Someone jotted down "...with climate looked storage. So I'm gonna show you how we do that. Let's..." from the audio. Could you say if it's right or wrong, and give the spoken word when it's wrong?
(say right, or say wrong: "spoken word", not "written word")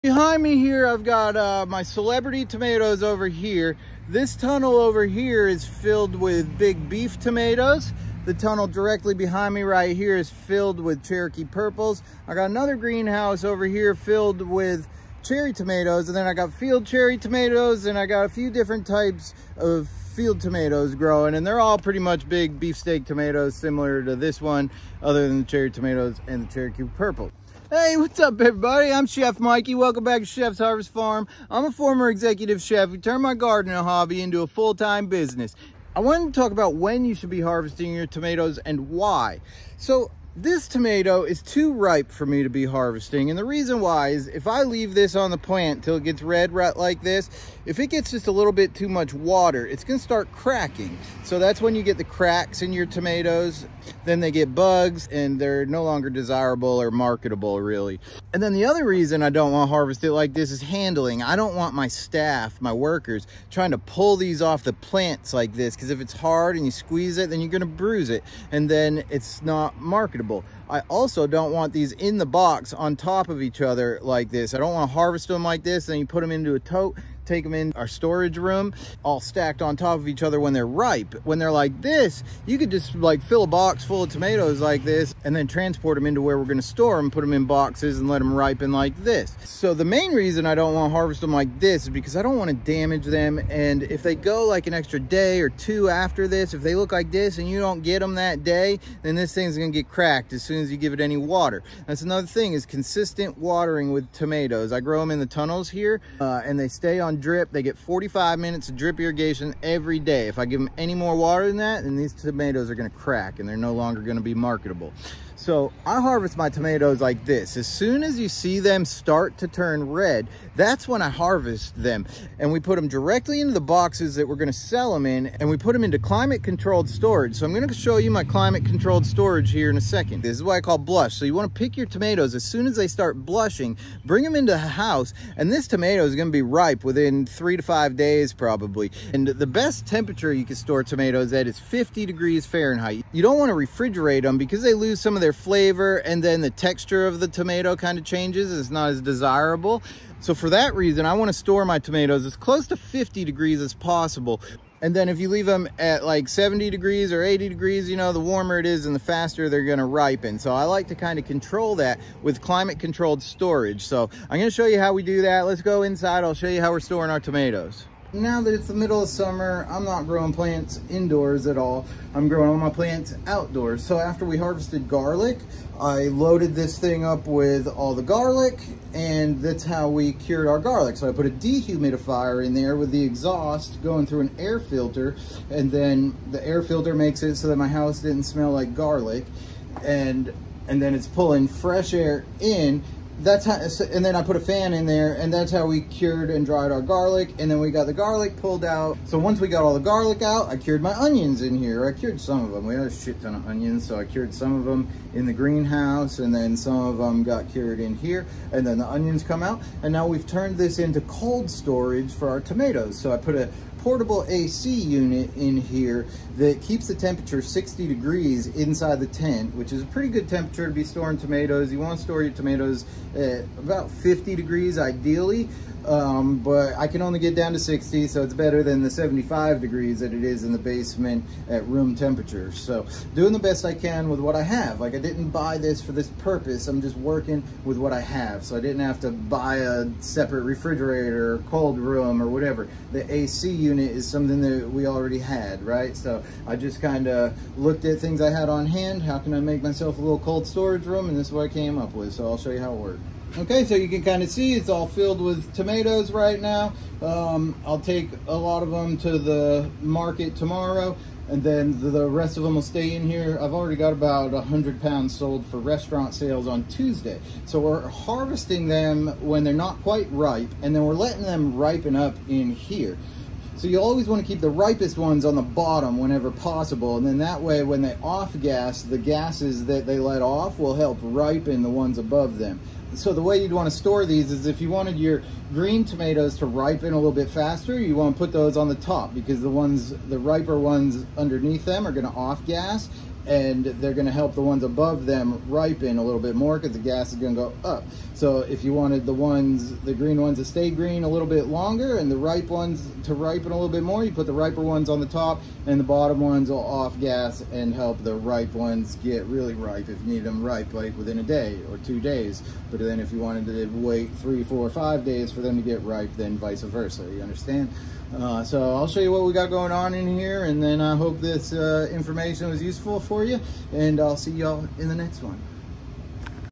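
wrong: "controlled", not "looked".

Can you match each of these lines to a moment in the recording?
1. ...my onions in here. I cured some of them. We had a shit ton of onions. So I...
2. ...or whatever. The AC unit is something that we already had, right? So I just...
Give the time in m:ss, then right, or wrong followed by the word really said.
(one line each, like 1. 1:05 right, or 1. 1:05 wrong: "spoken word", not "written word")
1. 3:20 right
2. 4:02 right.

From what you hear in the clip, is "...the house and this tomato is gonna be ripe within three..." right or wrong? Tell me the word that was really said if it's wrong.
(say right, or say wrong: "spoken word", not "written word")
right.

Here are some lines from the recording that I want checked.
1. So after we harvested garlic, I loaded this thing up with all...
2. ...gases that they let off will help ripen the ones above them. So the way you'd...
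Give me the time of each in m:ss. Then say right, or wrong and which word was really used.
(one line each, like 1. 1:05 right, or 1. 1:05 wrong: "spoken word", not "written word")
1. 2:53 right
2. 4:38 right.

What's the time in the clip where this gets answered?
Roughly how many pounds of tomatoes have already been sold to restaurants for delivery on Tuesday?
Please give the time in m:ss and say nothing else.
4:24.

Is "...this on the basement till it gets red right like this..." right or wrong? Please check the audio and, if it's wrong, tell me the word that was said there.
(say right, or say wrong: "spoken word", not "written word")
wrong: "plant", not "basement".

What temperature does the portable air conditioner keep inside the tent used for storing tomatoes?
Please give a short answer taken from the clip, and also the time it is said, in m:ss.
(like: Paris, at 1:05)
60 degrees, at 3:37.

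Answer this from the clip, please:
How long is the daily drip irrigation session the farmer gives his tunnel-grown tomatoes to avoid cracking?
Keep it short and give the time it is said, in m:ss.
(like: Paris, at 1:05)
45 minutes, at 1:47.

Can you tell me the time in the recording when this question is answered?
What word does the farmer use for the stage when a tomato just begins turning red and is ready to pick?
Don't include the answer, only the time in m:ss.
2:10.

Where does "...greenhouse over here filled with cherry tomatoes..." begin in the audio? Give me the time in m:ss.
0:12.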